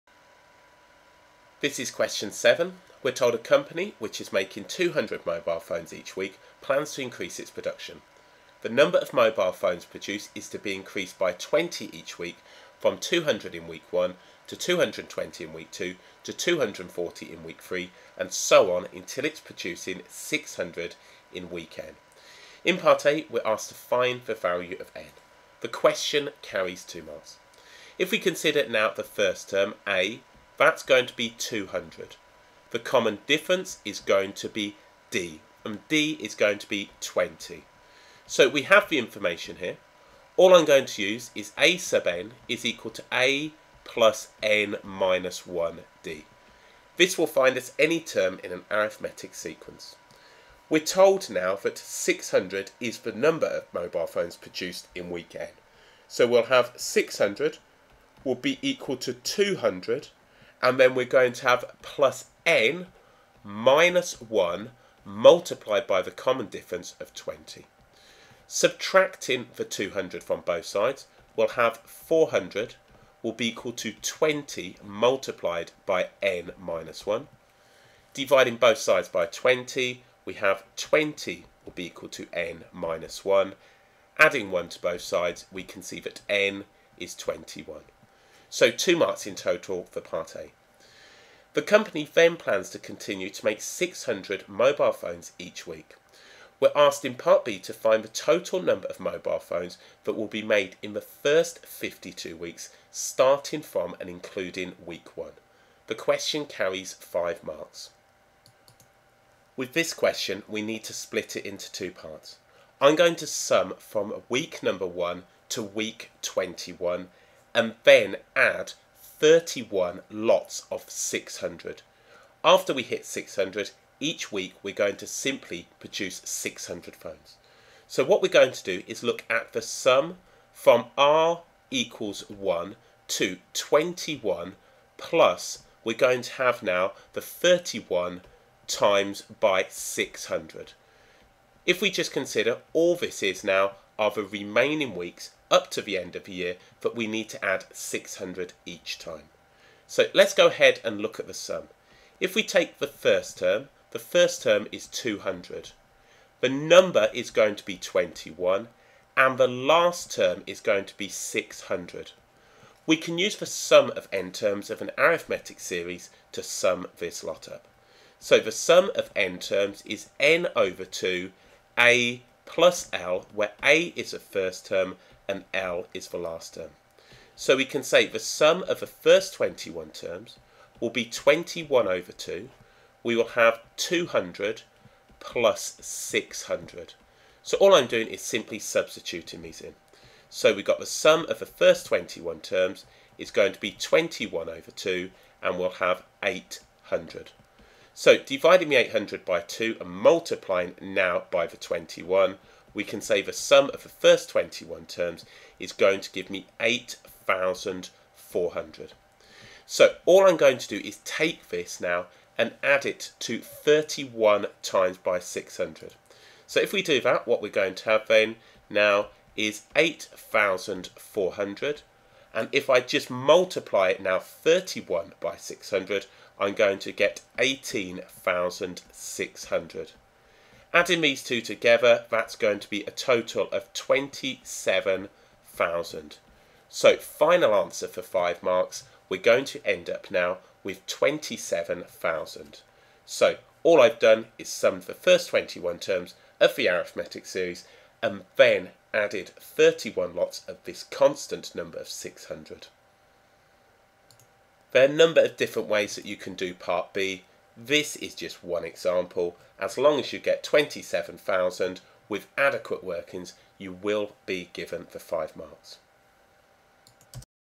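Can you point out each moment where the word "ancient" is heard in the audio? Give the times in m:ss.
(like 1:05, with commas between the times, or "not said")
not said.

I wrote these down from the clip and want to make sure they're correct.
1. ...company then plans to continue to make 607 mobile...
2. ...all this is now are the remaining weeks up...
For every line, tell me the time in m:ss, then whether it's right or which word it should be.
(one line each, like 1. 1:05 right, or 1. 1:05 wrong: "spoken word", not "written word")
1. 1:31 wrong: "600", not "607"
2. 2:22 right.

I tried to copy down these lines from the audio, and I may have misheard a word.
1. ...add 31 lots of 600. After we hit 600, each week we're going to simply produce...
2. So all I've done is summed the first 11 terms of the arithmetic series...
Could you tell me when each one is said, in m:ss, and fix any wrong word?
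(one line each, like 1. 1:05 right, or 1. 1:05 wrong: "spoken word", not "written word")
1. 1:58 right
2. 4:03 wrong: "21", not "11".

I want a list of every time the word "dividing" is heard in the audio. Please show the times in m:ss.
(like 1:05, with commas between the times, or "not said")
1:18, 3:18.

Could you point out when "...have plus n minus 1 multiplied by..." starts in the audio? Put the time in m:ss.
1:01.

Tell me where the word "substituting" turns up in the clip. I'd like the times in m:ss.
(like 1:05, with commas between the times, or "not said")
3:08.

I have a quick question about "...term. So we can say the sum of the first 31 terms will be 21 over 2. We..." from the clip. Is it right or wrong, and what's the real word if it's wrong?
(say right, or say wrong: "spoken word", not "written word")
wrong: "21", not "31".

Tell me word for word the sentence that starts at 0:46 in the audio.
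This will find us any term in an arithmetic sequence.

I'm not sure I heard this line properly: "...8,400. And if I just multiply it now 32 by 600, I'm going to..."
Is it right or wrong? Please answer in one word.
wrong.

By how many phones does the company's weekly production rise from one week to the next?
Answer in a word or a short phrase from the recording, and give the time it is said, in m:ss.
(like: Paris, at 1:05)
20, at 0:10.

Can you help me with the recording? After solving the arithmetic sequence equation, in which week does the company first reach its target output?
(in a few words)
21.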